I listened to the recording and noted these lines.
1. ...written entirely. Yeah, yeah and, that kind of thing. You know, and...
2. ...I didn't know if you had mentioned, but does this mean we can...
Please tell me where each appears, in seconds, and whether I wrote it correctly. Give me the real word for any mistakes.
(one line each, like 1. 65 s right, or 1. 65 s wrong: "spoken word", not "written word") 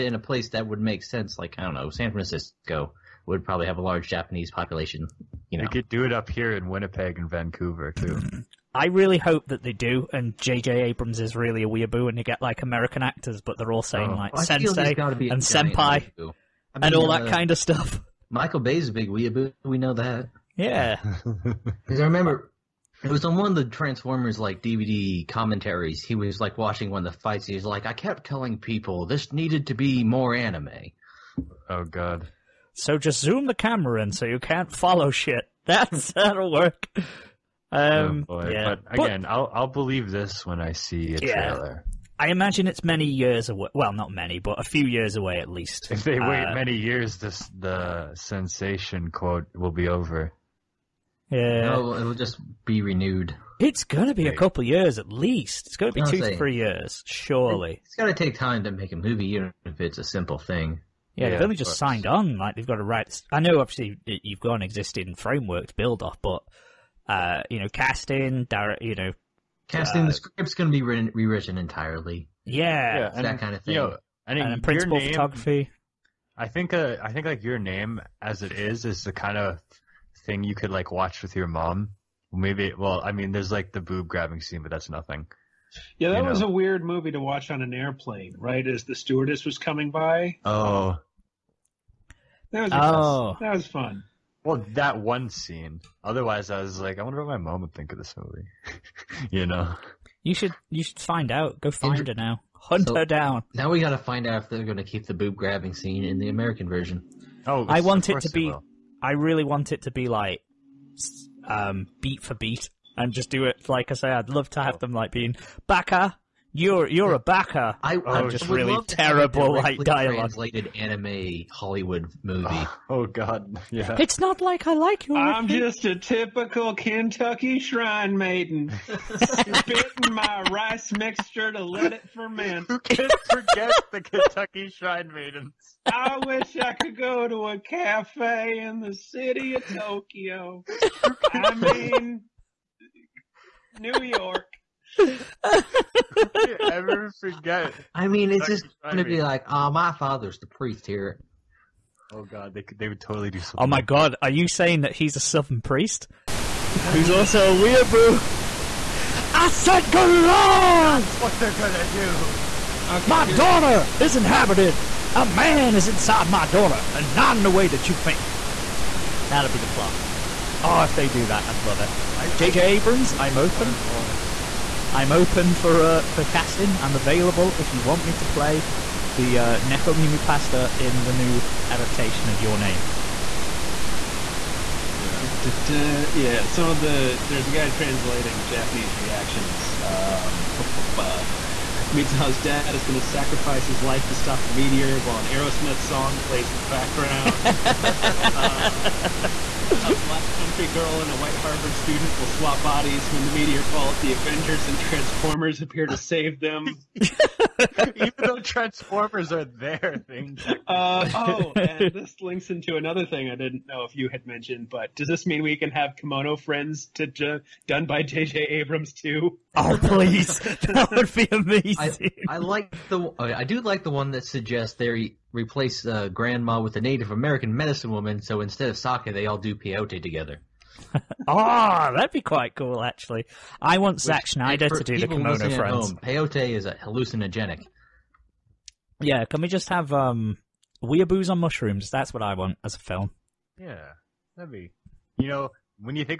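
1. 71 s wrong: "rewritten", not "written"
2. 213 s right.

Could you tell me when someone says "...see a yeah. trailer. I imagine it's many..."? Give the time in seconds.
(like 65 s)
40 s.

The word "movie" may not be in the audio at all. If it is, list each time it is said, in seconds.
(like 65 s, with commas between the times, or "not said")
58 s, 86 s, 98 s, 122 s.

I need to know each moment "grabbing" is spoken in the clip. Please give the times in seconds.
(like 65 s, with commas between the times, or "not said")
84 s, 105 s.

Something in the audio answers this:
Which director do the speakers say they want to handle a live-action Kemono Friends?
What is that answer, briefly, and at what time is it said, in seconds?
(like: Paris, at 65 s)
Zack Snyder, at 234 s.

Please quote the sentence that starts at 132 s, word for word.
Who can forget the Kentucky shrine maidens?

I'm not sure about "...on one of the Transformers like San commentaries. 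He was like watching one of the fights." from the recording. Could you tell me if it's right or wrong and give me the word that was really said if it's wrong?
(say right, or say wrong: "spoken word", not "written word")
wrong: "DVD", not "San".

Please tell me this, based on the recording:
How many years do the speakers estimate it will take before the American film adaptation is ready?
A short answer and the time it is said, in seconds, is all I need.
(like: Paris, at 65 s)
2 to 3 years, at 56 s.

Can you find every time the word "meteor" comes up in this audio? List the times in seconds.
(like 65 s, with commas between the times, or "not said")
194 s, 203 s.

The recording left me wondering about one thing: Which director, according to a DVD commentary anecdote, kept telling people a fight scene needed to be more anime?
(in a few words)
Michael Bay.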